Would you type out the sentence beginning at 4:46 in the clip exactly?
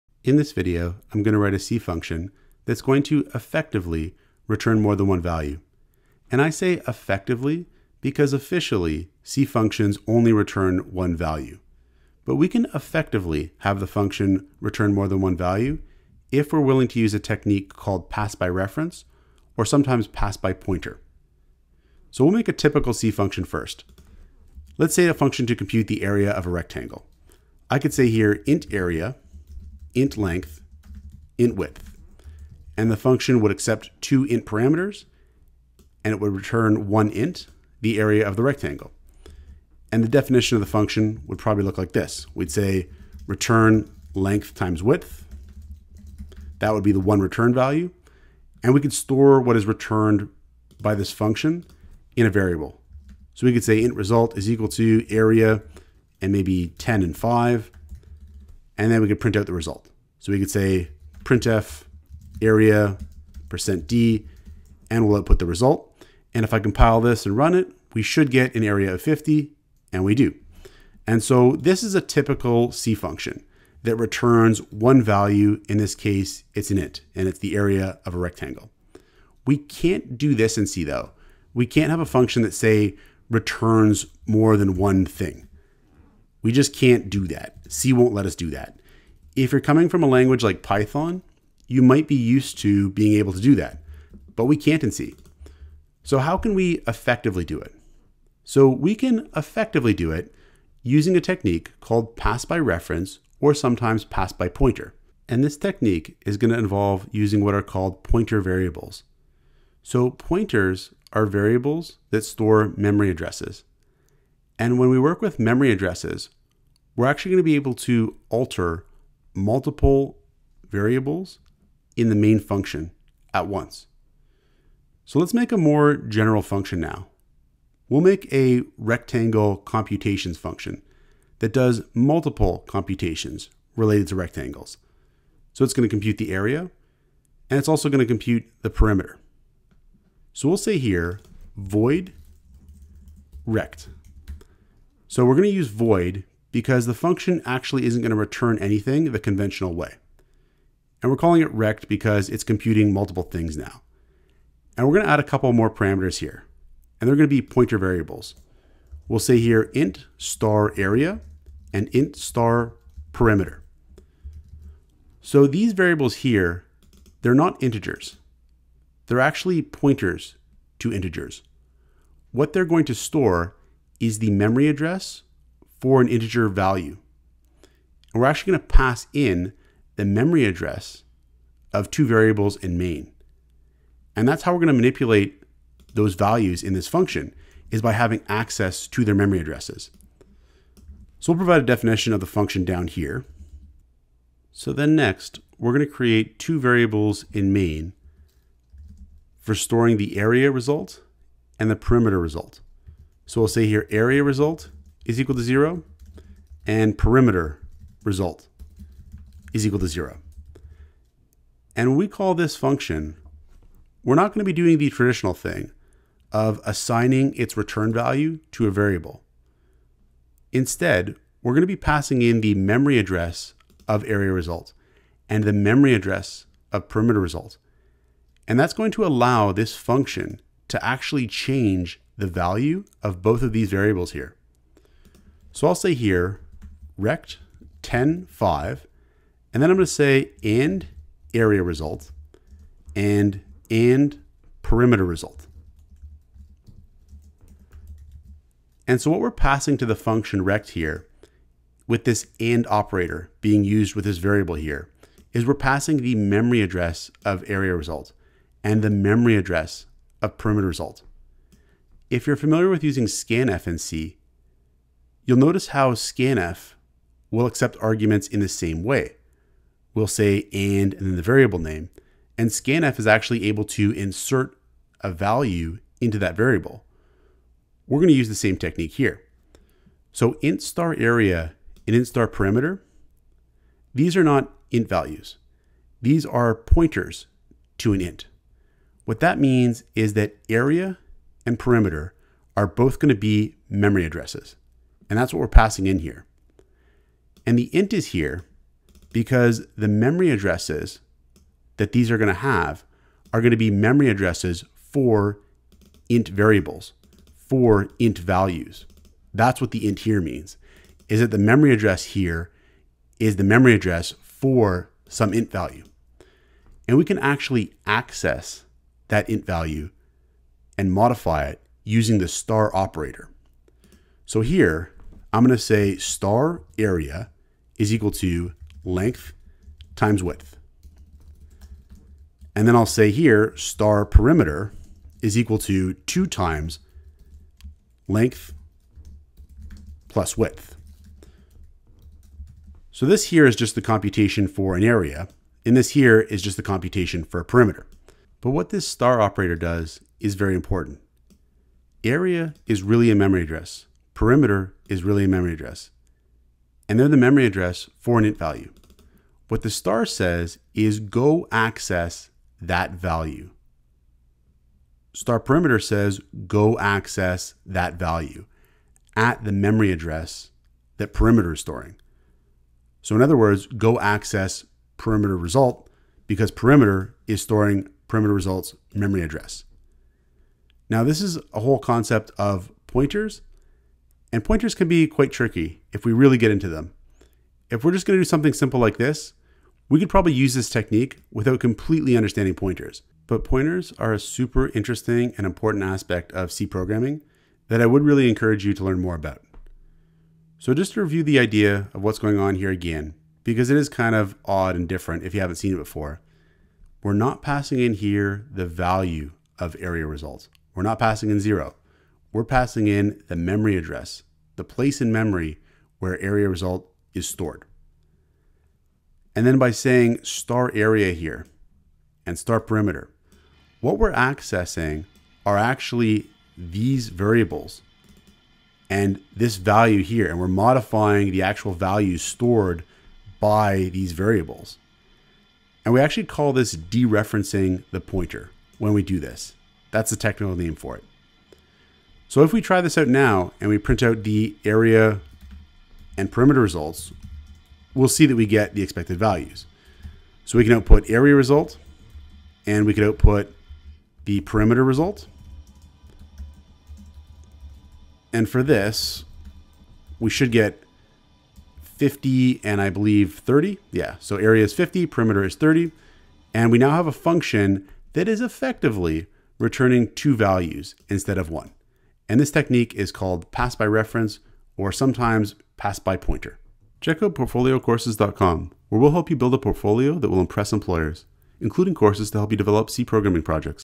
These are pointers to an int.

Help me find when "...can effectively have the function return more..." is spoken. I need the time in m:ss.
0:12.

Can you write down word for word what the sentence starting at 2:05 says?
So let's make a more general function now.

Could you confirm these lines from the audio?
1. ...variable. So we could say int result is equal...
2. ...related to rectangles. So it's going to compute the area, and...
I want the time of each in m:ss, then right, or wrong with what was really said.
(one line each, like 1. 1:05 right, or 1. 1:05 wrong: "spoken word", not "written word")
1. 0:52 right
2. 2:13 right.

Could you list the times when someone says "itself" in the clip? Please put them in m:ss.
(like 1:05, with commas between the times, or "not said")
not said.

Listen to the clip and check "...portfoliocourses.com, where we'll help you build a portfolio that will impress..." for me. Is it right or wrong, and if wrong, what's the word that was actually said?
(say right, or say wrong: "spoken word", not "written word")
right.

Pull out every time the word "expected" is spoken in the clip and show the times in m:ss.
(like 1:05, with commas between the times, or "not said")
7:28.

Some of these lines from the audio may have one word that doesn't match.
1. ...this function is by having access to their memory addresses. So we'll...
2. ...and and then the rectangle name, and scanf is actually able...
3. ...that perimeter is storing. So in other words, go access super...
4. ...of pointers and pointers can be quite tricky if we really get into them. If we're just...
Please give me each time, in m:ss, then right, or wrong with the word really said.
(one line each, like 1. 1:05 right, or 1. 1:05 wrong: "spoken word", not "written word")
1. 3:06 right
2. 4:30 wrong: "variable", not "rectangle"
3. 6:10 wrong: "perimeter", not "super"
4. 6:22 right.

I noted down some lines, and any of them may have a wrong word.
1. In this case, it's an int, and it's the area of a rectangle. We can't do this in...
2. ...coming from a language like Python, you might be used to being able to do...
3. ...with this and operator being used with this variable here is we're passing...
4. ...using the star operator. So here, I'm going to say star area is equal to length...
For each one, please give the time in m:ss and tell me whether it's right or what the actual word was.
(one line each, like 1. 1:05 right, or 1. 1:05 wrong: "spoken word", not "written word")
1. 1:15 right
2. 1:29 right
3. 4:11 right
4. 5:21 right.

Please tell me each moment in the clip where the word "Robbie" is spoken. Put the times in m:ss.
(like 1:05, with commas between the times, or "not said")
not said.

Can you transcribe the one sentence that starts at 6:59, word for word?
And then by saying star area here and star perimeter, what we're accessing are actually these variables and this value here.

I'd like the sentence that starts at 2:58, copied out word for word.
And we're actually going to pass in the memory address of two variables in main.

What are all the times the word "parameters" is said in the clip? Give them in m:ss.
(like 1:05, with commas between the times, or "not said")
0:34, 2:35.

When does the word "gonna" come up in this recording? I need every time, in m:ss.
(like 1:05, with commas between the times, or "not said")
3:34, 3:41.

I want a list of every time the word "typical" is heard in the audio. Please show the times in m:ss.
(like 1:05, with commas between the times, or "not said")
0:22, 1:12.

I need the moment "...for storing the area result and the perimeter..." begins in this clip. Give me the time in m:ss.
3:19.